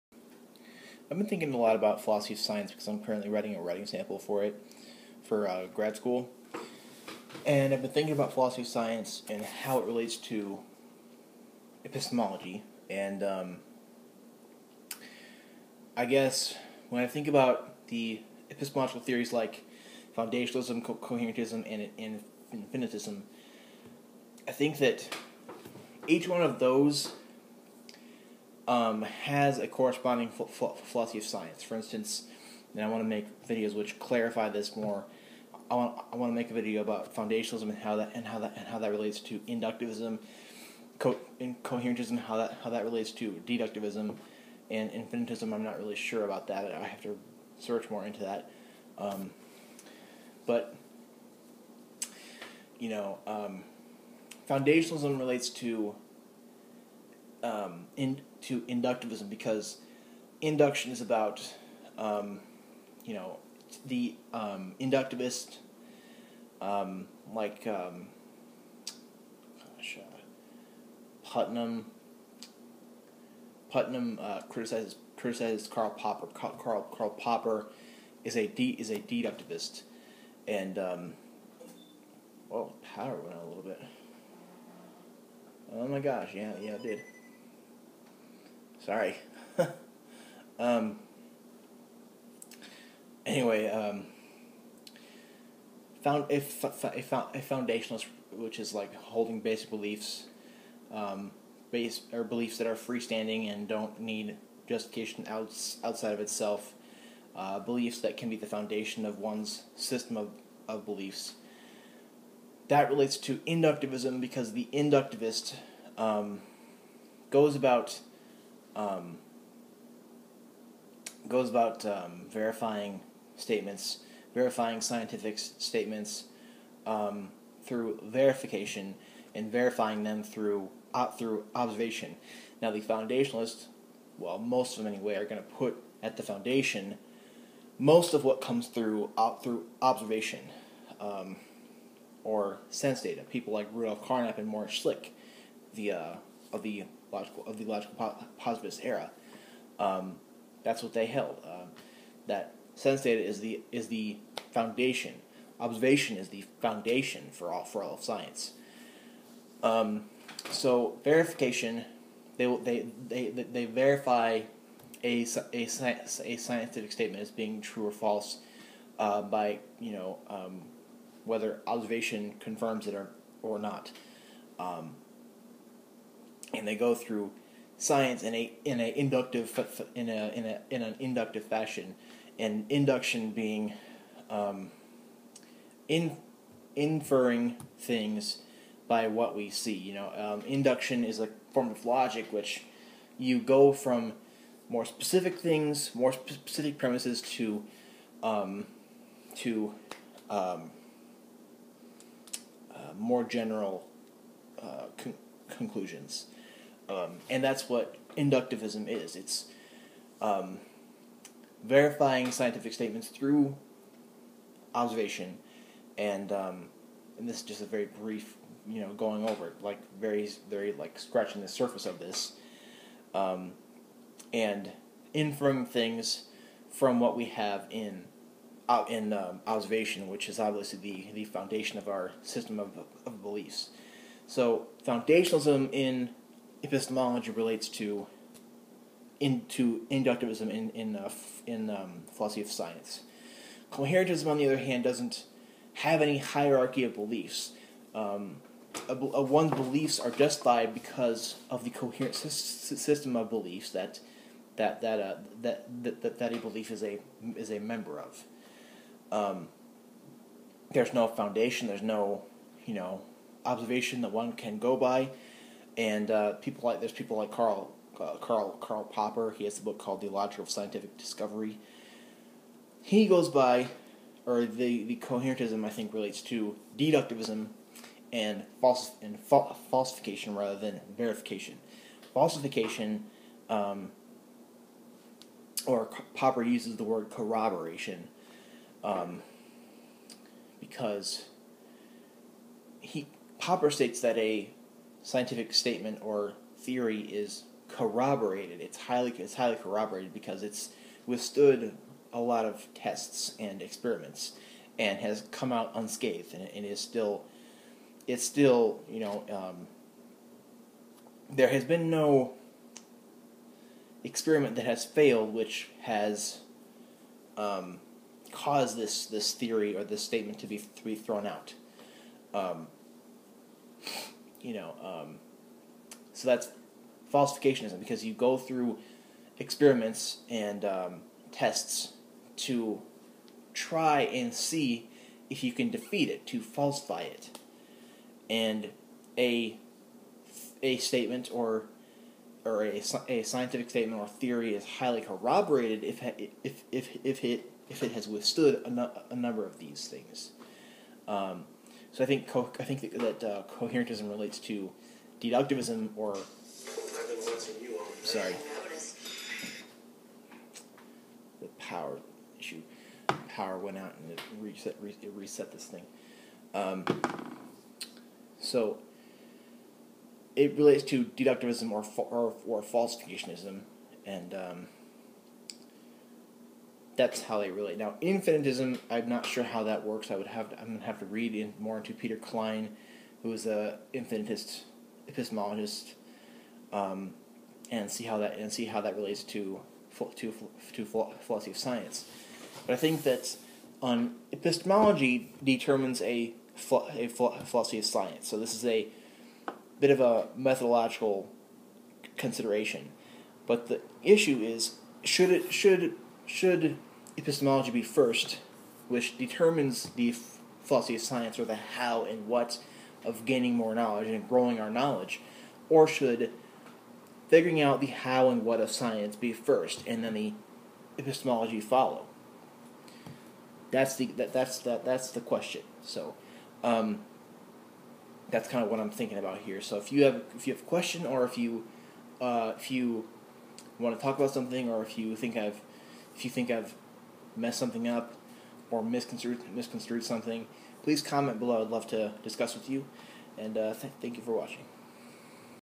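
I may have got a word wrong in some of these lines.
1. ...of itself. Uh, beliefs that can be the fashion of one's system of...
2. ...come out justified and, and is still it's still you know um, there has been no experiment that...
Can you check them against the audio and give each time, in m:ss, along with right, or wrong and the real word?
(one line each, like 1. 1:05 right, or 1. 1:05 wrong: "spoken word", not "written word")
1. 1:46 wrong: "foundation", not "fashion"
2. 5:05 wrong: "unscathed", not "justified".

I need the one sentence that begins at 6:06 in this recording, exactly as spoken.
Um, so it relates to deductivism or, fa- or, or falsificationism.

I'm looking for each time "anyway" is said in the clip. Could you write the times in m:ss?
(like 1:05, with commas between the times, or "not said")
1:33, 2:14.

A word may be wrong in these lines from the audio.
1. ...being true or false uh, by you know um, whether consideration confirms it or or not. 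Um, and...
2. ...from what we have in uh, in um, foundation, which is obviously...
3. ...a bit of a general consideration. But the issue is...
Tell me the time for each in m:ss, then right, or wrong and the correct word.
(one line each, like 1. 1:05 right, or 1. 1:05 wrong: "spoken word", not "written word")
1. 2:47 wrong: "observation", not "consideration"
2. 3:46 wrong: "observation", not "foundation"
3. 6:38 wrong: "methodological", not "general".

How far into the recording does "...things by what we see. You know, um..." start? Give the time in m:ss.
3:07.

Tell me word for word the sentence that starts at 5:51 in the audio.
Um, so I think co- I think that, that uh, coherentism relates to deductivism or.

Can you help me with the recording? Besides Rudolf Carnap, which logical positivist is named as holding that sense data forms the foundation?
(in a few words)
Moritz Schlick.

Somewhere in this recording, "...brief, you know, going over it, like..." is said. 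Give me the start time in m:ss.
3:37.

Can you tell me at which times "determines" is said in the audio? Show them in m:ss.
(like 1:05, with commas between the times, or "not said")
6:35, 6:49.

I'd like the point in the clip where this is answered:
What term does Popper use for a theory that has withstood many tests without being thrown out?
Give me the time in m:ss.
4:47.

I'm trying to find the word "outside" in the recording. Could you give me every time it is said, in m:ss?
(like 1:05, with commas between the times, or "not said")
1:45.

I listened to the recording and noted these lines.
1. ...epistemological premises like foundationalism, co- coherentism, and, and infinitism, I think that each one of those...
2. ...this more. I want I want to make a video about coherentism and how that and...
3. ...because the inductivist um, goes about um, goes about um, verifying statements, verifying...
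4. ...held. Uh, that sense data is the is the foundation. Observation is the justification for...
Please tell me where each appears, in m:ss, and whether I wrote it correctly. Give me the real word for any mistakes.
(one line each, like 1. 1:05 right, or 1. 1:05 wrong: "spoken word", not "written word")
1. 0:18 wrong: "theories", not "premises"
2. 0:34 wrong: "foundationalism", not "coherentism"
3. 1:54 right
4. 2:31 wrong: "foundation", not "justification".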